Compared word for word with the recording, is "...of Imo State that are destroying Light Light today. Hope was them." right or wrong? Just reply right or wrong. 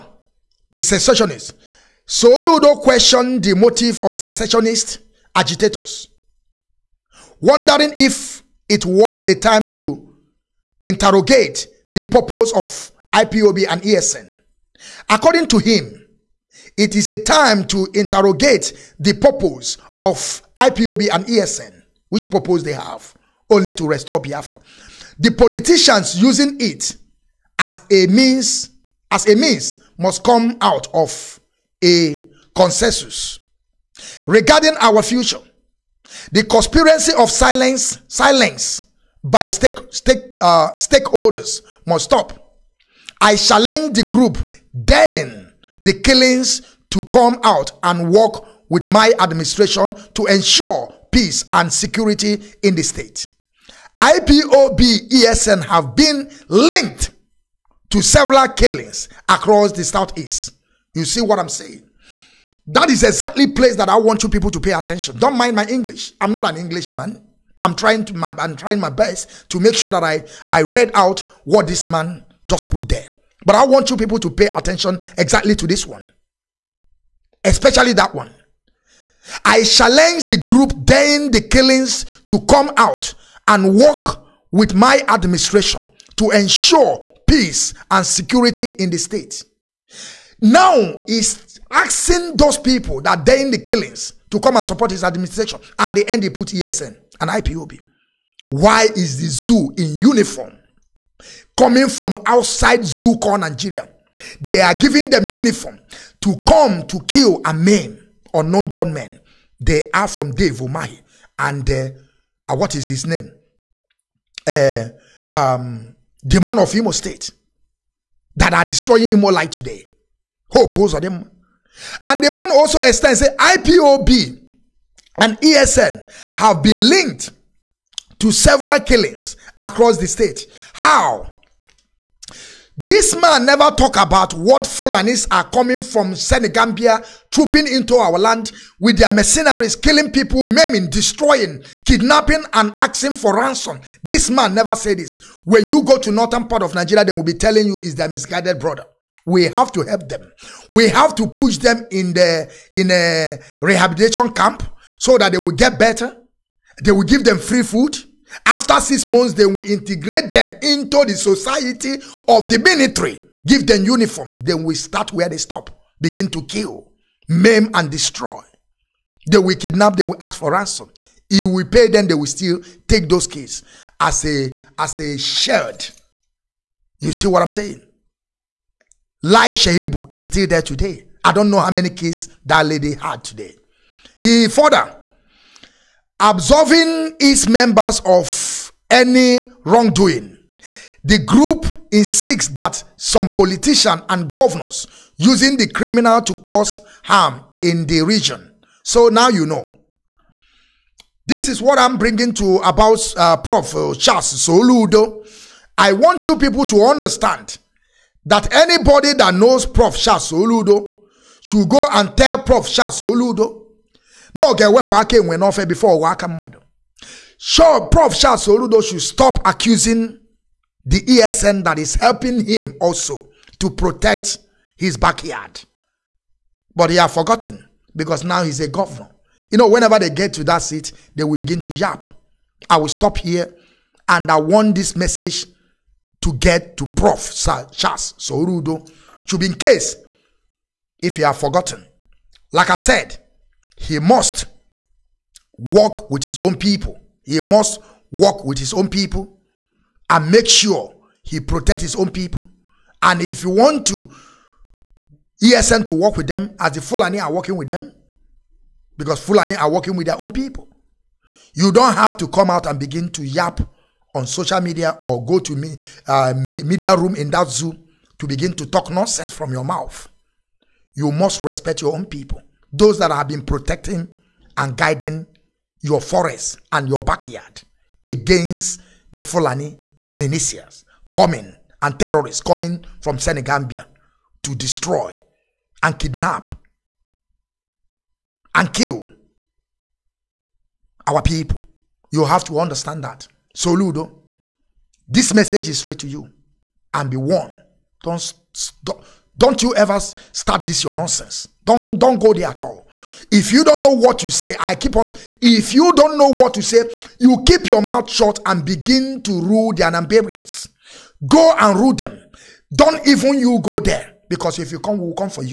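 wrong.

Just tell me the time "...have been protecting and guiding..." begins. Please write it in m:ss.
4:33.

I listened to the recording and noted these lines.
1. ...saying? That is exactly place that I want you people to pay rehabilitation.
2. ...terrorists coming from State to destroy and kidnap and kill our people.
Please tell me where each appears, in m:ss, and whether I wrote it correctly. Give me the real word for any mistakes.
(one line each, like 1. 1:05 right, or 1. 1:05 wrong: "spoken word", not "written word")
1. 1:01 wrong: "attention", not "rehabilitation"
2. 4:41 wrong: "Senegambia", not "State".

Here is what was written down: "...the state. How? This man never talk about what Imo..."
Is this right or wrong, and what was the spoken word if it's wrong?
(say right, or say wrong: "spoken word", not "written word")
wrong: "Fulanis", not "Imo".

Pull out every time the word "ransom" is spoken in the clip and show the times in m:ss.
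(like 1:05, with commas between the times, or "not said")
2:23, 2:50.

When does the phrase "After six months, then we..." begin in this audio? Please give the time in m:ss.
2:38.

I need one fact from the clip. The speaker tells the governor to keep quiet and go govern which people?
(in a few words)
Anambarians.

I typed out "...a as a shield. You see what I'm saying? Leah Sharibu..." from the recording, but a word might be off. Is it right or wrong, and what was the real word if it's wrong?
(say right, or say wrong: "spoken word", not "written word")
right.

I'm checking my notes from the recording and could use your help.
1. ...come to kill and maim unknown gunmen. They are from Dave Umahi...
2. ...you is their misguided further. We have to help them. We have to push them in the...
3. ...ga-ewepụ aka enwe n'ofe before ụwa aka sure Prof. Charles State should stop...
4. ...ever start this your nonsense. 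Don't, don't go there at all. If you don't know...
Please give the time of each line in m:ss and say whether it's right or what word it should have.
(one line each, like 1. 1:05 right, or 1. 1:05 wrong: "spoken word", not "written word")
1. 1:46 right
2. 2:27 wrong: "brother", not "further"
3. 3:34 wrong: "Soludo", not "State"
4. 4:59 right.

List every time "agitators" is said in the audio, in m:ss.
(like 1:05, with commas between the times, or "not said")
0:05.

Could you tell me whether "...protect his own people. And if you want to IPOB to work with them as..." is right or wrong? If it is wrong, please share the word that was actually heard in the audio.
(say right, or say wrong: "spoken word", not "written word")
wrong: "ESN", not "IPOB".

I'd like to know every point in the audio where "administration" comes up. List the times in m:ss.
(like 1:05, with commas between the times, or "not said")
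0:49, 1:25, 1:35.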